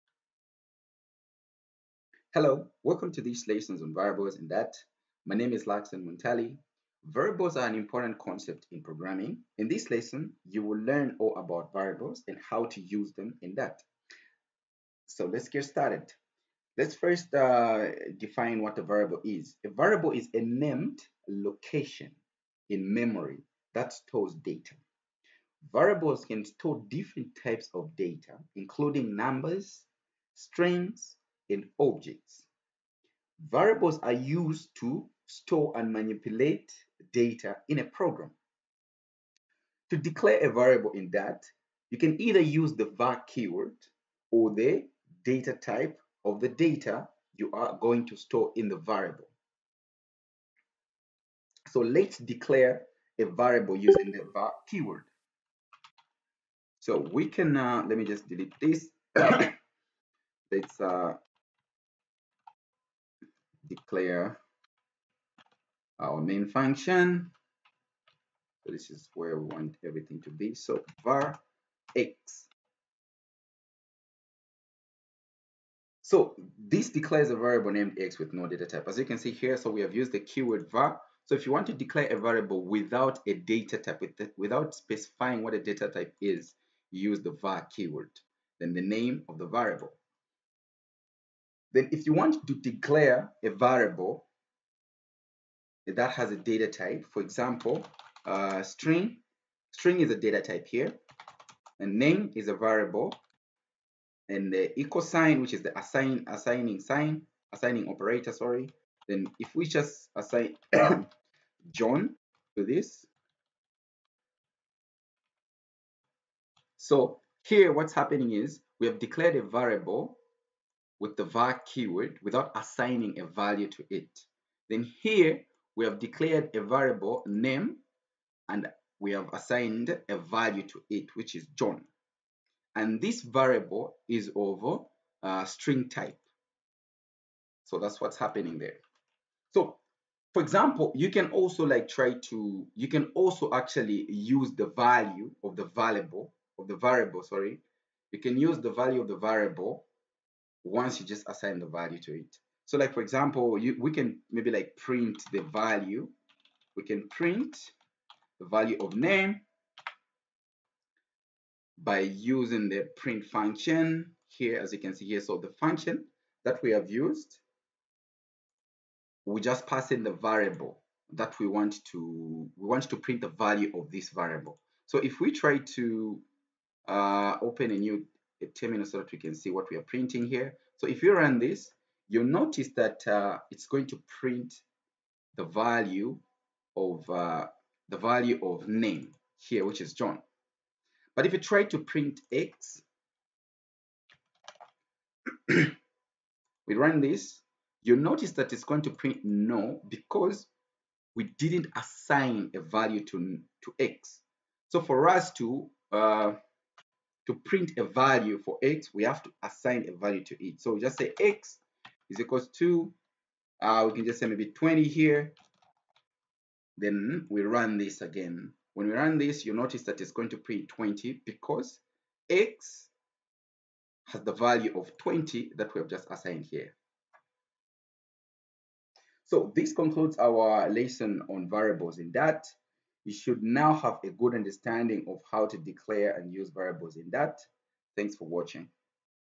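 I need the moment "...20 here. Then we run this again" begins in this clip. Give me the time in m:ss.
3:34.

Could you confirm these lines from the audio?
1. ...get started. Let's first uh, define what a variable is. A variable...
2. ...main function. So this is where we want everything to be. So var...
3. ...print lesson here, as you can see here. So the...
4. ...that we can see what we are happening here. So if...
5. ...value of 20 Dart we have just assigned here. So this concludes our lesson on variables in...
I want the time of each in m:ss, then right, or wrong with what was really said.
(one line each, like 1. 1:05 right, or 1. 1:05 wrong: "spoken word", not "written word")
1. 0:15 right
2. 1:06 right
3. 2:42 wrong: "function", not "lesson"
4. 2:58 wrong: "printing", not "happening"
5. 3:44 right.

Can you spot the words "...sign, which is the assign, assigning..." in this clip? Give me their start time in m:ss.
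1:45.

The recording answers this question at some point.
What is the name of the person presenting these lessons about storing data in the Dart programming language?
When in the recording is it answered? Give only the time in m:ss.
0:05.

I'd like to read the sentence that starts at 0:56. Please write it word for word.
So we can, uh, let me just delete this.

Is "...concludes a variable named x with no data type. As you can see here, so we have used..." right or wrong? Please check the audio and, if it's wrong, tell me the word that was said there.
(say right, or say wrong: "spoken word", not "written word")
wrong: "declares", not "concludes".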